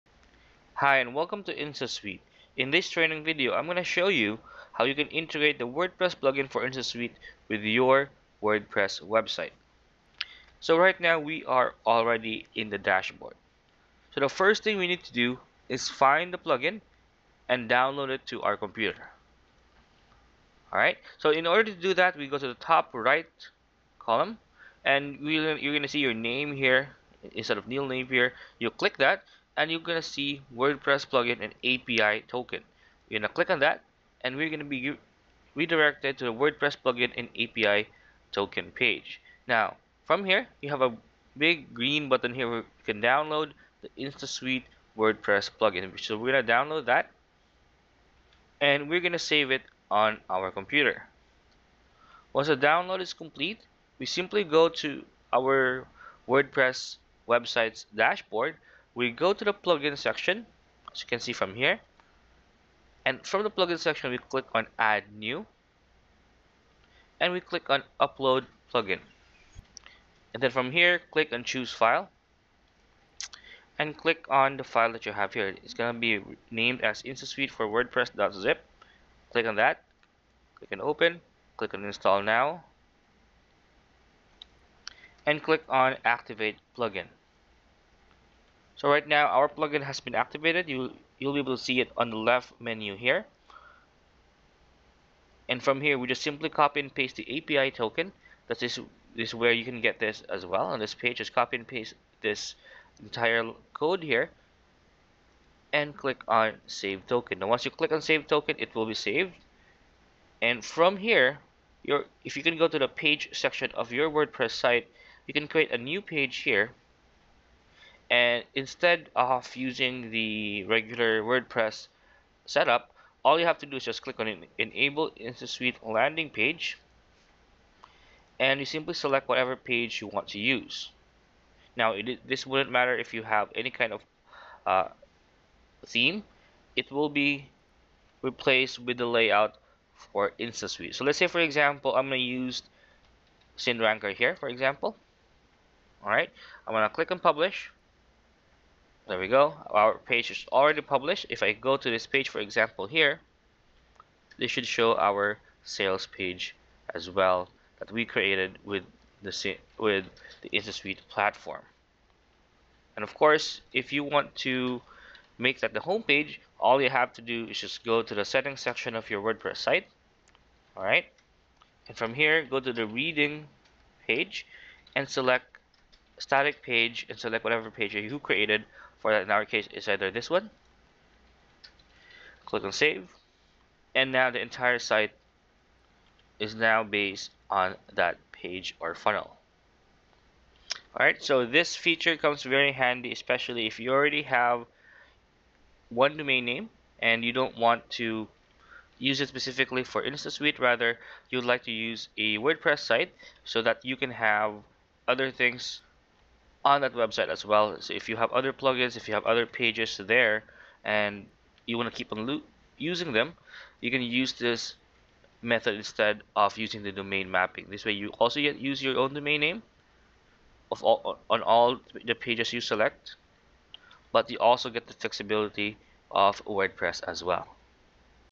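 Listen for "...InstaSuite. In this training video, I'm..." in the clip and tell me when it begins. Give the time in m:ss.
0:01.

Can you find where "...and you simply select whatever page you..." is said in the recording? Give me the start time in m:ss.
2:08.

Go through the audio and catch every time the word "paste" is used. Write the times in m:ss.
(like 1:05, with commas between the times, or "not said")
1:36, 1:41.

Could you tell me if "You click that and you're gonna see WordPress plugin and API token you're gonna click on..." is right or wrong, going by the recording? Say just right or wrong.
right.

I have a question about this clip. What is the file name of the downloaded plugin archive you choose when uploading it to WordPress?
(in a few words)
InstaSuite for WordPress.zip.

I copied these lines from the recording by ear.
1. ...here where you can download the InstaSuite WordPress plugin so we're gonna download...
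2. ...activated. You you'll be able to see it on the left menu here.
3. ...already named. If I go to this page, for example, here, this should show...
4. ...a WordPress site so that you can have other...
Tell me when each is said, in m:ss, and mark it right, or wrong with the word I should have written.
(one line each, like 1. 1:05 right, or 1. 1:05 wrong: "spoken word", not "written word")
1. 0:42 right
2. 1:30 right
3. 2:30 wrong: "published", not "named"
4. 3:22 right.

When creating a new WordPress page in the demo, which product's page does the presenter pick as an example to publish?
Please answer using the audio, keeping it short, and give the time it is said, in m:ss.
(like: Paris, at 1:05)
SynRanker, at 2:23.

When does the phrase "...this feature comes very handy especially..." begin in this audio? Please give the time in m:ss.
3:11.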